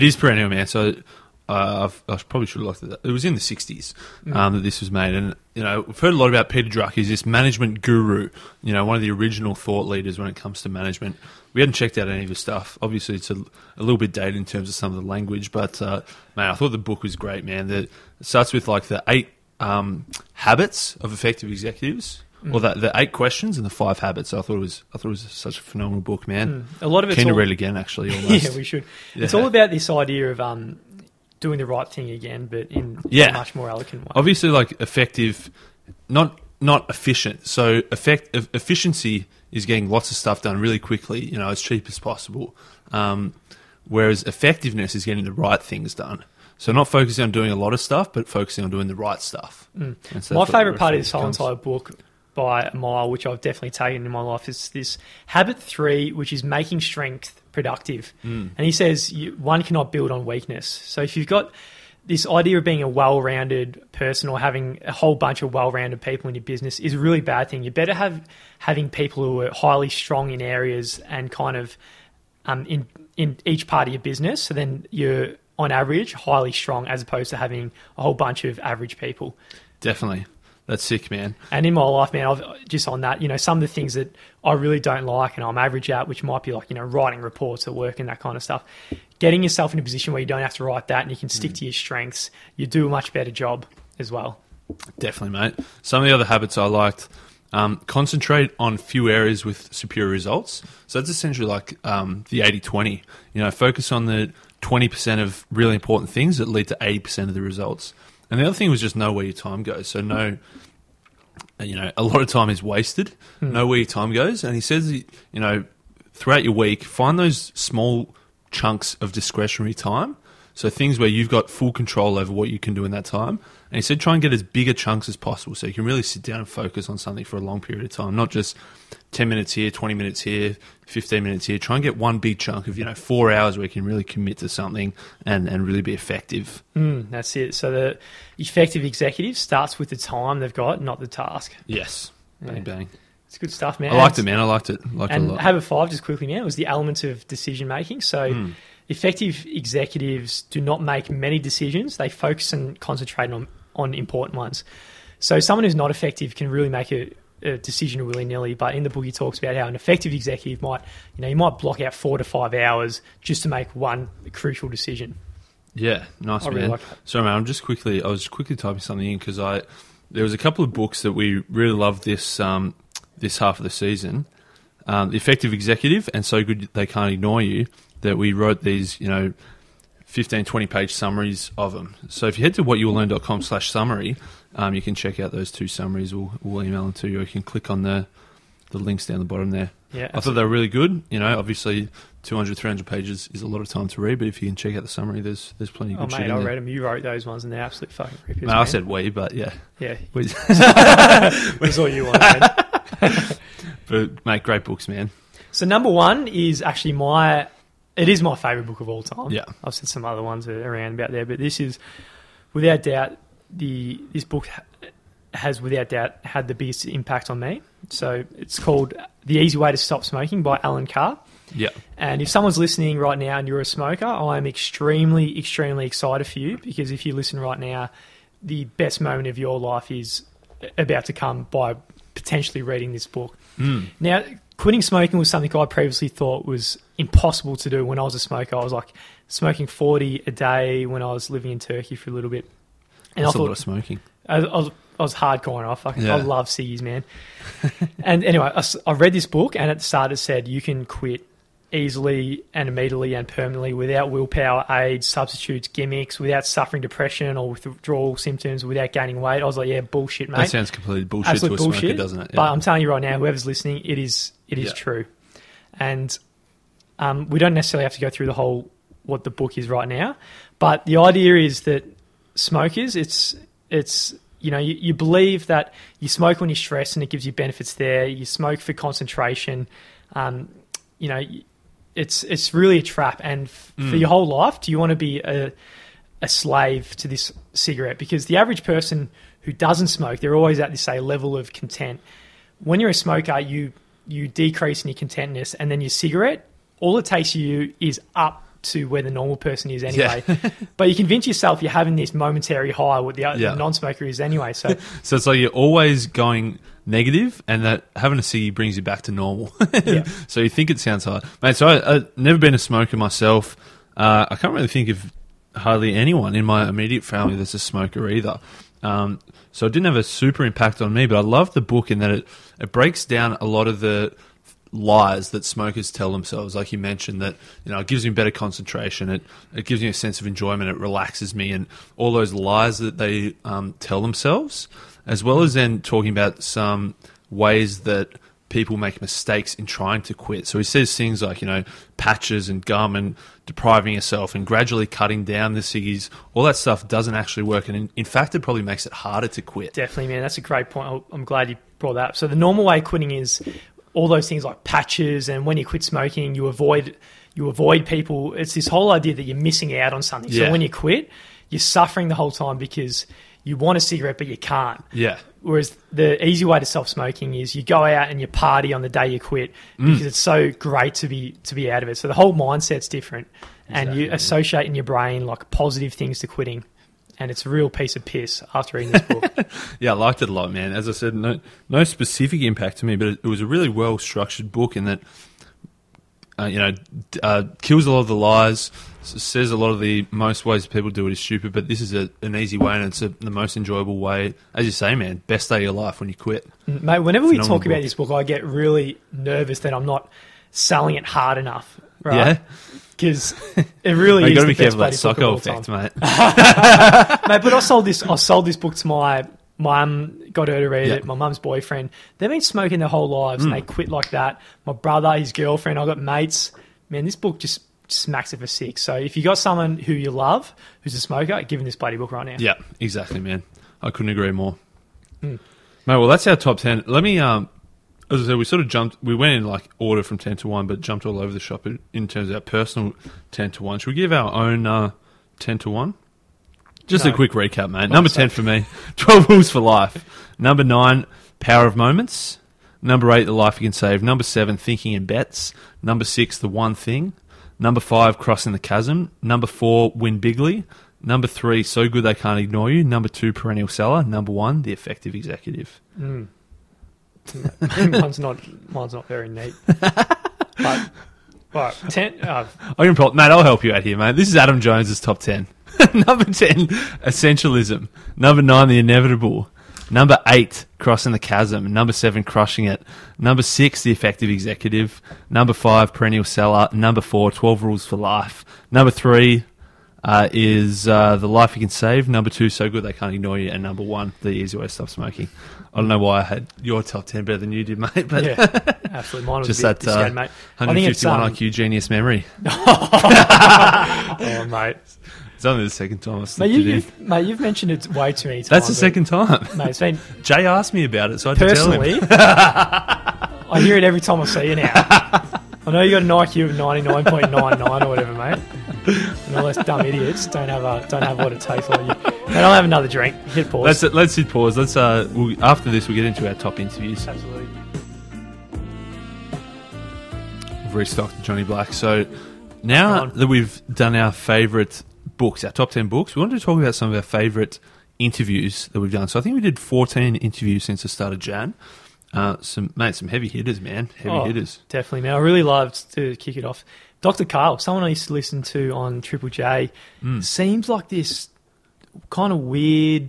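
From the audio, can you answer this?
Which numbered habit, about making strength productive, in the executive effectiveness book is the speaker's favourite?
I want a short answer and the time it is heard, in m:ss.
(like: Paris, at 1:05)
Habit three, at 0:55.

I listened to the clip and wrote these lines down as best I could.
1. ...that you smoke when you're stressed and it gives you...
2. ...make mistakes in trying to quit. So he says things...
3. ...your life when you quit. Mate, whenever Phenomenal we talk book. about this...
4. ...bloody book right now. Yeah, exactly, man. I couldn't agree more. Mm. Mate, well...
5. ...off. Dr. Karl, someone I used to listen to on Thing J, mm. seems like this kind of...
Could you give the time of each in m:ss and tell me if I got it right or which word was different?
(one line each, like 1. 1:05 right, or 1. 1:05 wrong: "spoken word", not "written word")
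1. 4:35 right
2. 5:38 right
3. 6:35 right
4. 7:01 right
5. 8:56 wrong: "Triple", not "Thing".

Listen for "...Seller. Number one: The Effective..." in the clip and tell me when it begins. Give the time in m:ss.
7:33.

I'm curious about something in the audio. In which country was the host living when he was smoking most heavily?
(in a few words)
Turkey.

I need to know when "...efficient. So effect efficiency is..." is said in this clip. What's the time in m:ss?
0:36.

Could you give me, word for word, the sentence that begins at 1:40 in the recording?
So that's essentially like um, the 80 20.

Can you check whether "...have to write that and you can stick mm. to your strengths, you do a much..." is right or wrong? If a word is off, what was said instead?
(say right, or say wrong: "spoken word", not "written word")
right.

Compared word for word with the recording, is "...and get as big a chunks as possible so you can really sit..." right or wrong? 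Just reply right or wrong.
right.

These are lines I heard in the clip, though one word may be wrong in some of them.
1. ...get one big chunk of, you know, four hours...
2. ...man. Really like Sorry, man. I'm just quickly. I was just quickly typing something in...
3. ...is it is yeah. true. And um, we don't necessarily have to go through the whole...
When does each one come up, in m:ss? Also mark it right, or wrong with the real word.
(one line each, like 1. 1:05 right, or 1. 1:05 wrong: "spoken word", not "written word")
1. 2:11 right
2. 2:46 right
3. 4:23 right.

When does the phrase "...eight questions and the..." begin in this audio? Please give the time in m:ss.
0:22.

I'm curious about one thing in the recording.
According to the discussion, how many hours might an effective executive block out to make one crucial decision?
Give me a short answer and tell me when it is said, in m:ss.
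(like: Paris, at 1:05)
4 to 5 hours, at 2:41.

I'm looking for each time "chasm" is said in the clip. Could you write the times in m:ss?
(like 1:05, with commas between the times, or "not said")
7:28, 7:51.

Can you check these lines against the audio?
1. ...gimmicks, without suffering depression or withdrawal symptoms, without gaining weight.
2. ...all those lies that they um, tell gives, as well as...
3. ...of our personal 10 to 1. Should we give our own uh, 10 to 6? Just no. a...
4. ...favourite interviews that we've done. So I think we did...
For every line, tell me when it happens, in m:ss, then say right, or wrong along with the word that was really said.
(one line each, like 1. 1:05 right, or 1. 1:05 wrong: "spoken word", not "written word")
1. 4:15 right
2. 5:31 wrong: "themselves", not "gives"
3. 7:12 wrong: "1", not "6"
4. 8:47 right.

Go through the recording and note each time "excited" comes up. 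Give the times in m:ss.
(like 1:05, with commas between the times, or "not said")
3:45.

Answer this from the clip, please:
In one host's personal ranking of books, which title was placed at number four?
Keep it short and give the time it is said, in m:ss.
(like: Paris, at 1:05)
Win Bigly, at 7:29.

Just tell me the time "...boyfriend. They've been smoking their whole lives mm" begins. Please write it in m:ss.
6:51.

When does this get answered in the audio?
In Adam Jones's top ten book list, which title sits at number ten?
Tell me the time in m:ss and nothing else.
7:47.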